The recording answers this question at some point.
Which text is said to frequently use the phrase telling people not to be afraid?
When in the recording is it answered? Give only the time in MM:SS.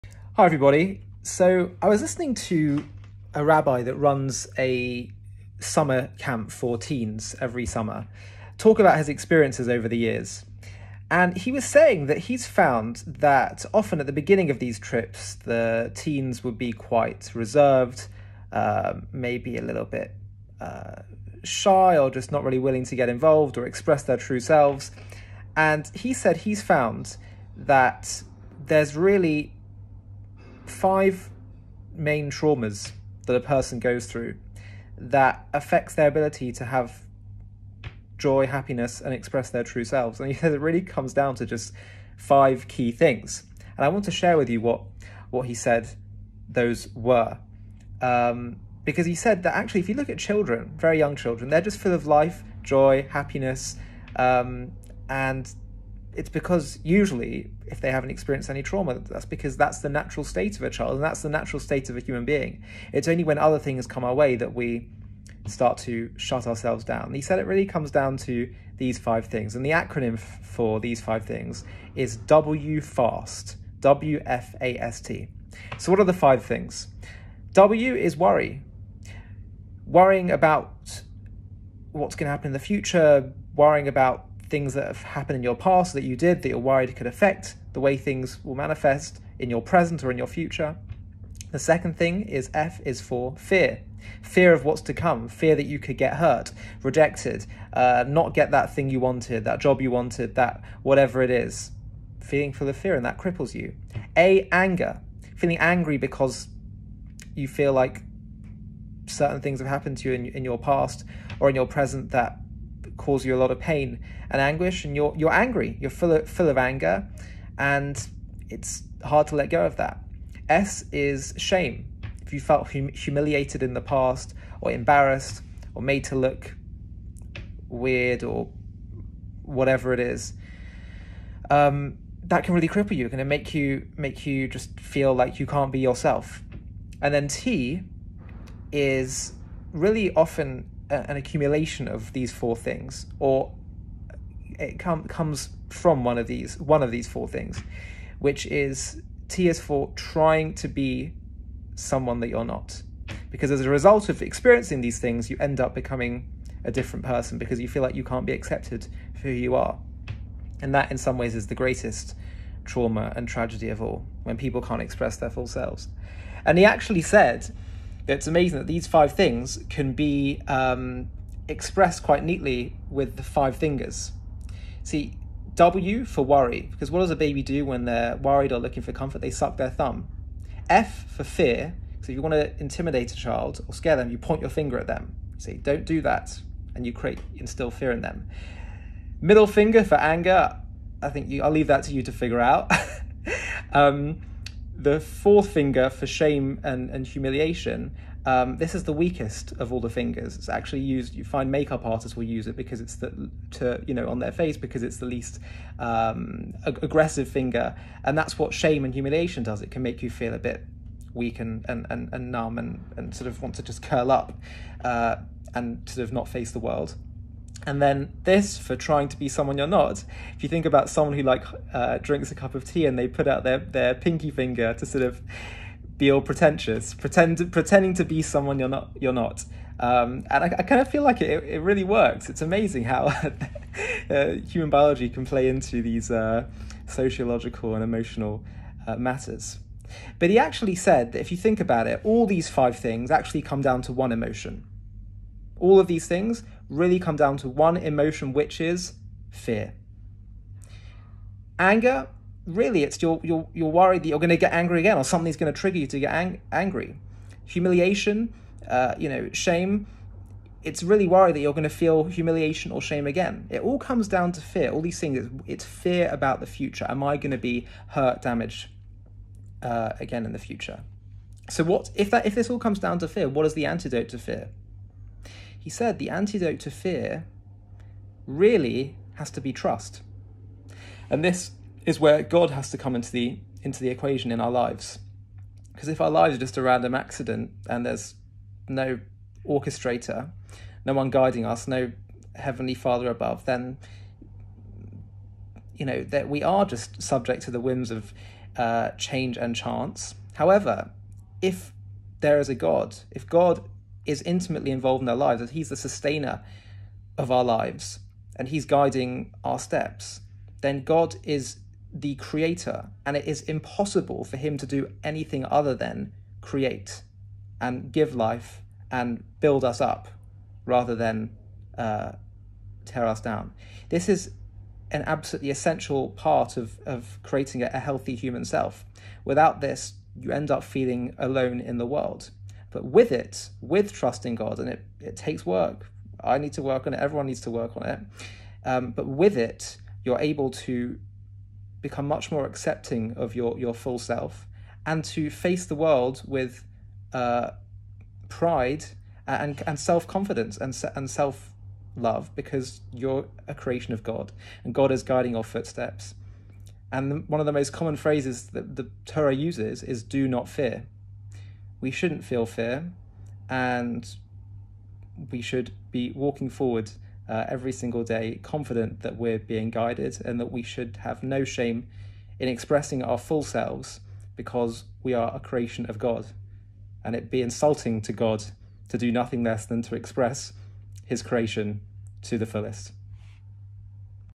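05:58.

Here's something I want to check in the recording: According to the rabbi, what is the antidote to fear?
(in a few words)
Trust.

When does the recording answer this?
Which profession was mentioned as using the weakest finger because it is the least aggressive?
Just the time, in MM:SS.
03:21.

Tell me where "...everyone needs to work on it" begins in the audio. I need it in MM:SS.
05:36.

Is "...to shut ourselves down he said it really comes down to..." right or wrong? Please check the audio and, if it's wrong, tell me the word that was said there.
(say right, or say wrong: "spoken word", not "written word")
right.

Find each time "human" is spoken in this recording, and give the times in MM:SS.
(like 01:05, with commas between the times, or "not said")
01:01, 03:54, 05:28.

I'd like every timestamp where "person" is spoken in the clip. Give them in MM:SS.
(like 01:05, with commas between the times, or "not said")
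00:33, 02:37.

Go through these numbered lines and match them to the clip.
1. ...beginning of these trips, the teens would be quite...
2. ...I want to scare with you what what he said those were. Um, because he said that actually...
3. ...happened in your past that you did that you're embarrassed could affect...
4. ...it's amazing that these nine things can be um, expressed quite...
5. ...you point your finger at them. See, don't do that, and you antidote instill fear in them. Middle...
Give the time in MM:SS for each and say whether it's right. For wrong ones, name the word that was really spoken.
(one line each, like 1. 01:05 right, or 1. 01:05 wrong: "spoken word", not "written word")
1. 00:14 right
2. 00:43 wrong: "share", not "scare"
3. 01:25 wrong: "worried", not "embarrassed"
4. 02:48 wrong: "five", not "nine"
5. 03:04 wrong: "create", not "antidote".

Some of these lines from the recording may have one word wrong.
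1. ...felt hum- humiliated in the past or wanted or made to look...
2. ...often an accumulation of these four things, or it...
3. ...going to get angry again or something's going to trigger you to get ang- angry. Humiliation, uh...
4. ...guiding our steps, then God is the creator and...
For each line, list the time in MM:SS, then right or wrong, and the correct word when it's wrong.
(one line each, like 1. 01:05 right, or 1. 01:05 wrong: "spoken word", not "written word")
1. 02:02 wrong: "embarrassed", not "wanted"
2. 02:20 right
3. 04:14 right
4. 05:08 right.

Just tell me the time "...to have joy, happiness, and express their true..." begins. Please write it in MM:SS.
00:36.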